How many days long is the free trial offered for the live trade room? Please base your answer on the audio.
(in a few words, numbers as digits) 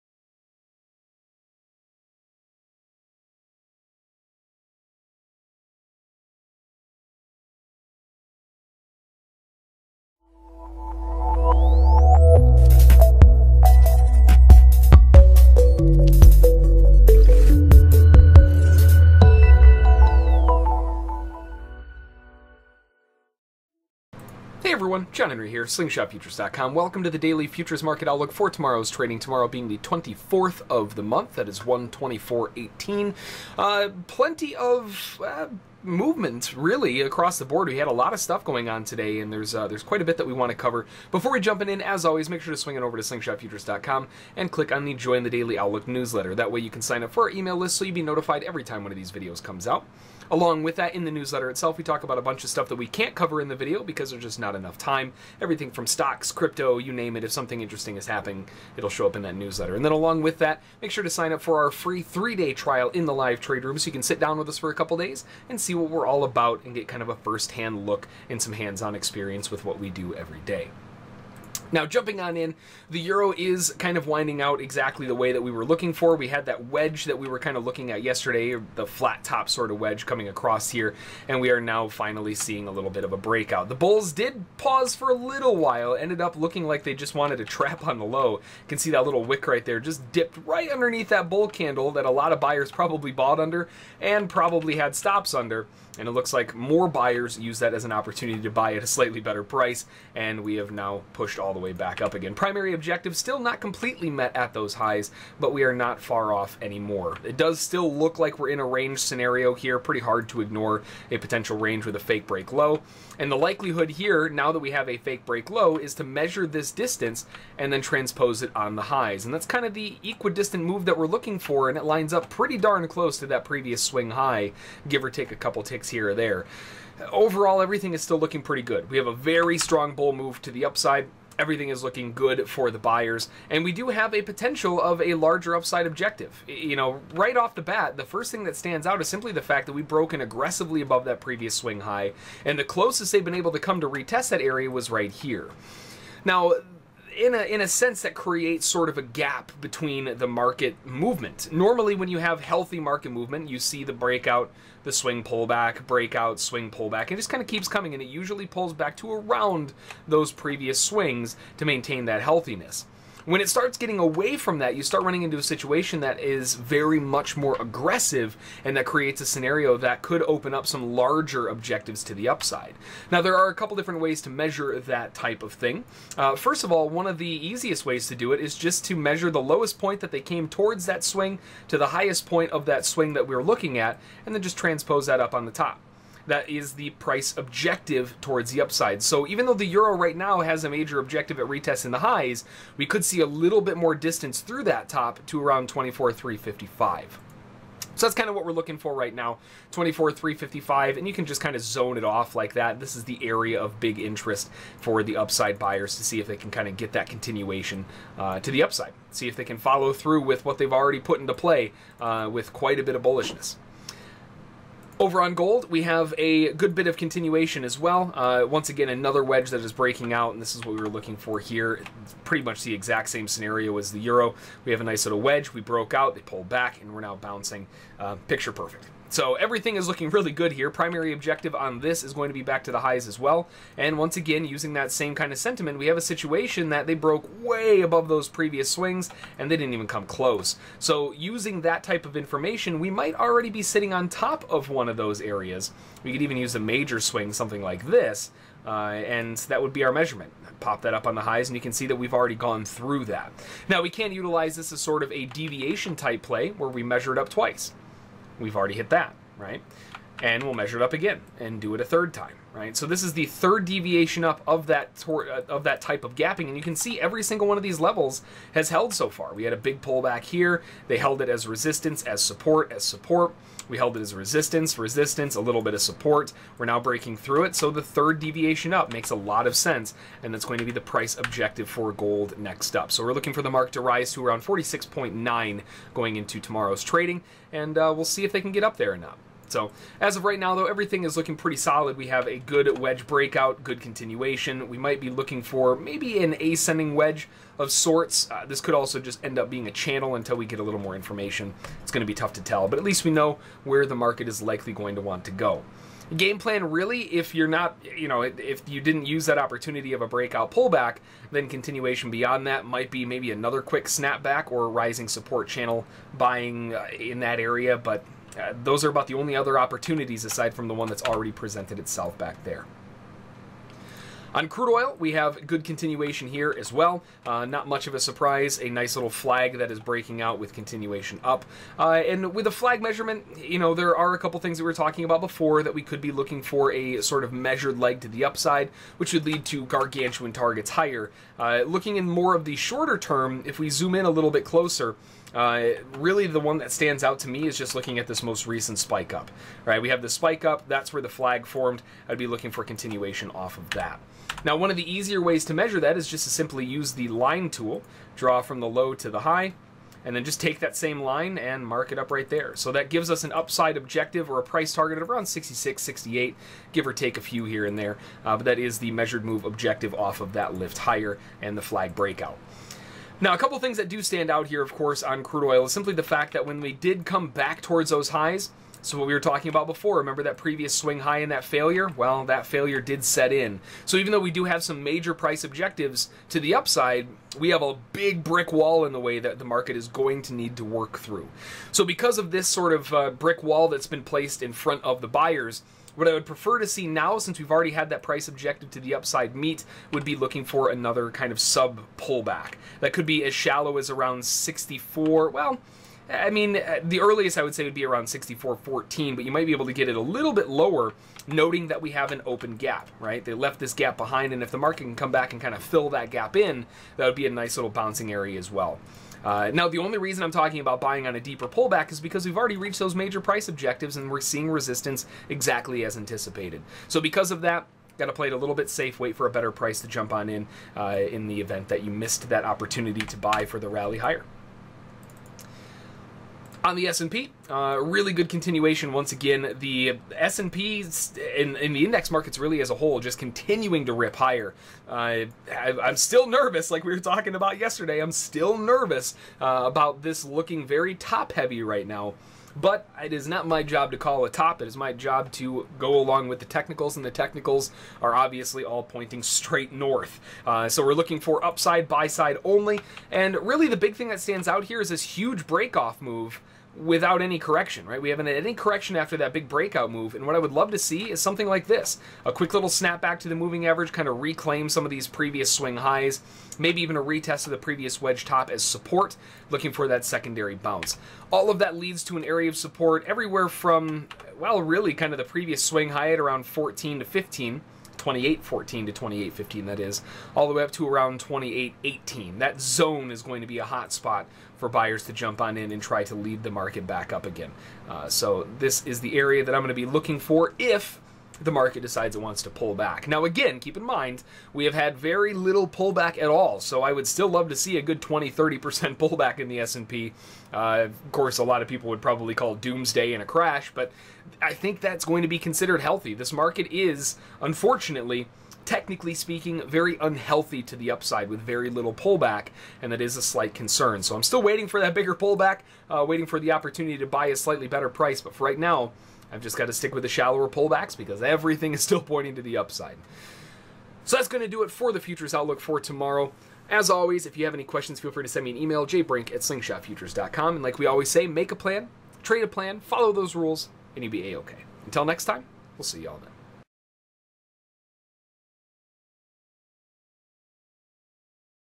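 3.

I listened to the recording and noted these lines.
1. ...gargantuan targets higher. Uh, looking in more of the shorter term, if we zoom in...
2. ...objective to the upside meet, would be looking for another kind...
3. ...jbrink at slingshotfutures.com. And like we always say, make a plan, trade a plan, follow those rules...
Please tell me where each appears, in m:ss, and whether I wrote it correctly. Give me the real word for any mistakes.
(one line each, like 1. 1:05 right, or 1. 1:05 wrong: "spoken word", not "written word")
1. 5:39 right
2. 6:38 right
3. 8:58 right.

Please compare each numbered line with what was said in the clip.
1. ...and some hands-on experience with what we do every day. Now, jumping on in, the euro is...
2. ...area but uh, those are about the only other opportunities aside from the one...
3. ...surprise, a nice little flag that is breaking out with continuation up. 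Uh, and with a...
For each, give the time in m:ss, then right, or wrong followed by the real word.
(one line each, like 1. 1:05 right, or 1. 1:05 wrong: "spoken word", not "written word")
1. 1:08 right
2. 5:17 right
3. 5:27 right.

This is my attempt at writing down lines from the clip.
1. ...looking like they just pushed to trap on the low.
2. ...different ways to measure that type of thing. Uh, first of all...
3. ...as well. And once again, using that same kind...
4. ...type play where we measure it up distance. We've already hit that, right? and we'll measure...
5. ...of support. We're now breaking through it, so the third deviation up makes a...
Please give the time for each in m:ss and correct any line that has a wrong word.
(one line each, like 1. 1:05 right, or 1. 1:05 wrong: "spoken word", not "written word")
1. 1:26 wrong: "wanted", not "pushed"
2. 2:53 right
3. 3:53 right
4. 4:15 wrong: "twice", not "distance"
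5. 4:35 right.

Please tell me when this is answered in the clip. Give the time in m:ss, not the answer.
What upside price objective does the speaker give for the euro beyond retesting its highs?
3:15.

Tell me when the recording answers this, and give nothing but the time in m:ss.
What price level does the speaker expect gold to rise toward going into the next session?
4:44.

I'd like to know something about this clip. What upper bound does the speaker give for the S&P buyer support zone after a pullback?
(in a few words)
2818.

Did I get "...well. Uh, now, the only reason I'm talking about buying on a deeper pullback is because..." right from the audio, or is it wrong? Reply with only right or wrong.
right.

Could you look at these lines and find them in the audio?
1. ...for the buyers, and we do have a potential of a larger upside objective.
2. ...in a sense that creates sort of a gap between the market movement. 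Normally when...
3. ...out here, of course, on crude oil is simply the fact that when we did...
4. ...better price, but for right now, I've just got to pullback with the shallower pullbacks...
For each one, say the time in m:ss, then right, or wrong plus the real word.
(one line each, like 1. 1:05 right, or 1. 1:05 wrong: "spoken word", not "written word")
1. 2:12 right
2. 2:27 right
3. 6:14 right
4. 8:47 wrong: "stick", not "pullback".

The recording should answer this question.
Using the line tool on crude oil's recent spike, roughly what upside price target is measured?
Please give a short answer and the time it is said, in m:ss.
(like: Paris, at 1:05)
66.68, at 6:05.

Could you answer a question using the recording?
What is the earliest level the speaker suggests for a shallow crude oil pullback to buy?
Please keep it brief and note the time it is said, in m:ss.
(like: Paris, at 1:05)
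64.14, at 6:48.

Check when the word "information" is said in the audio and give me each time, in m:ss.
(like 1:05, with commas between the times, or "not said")
4:02, 5:00.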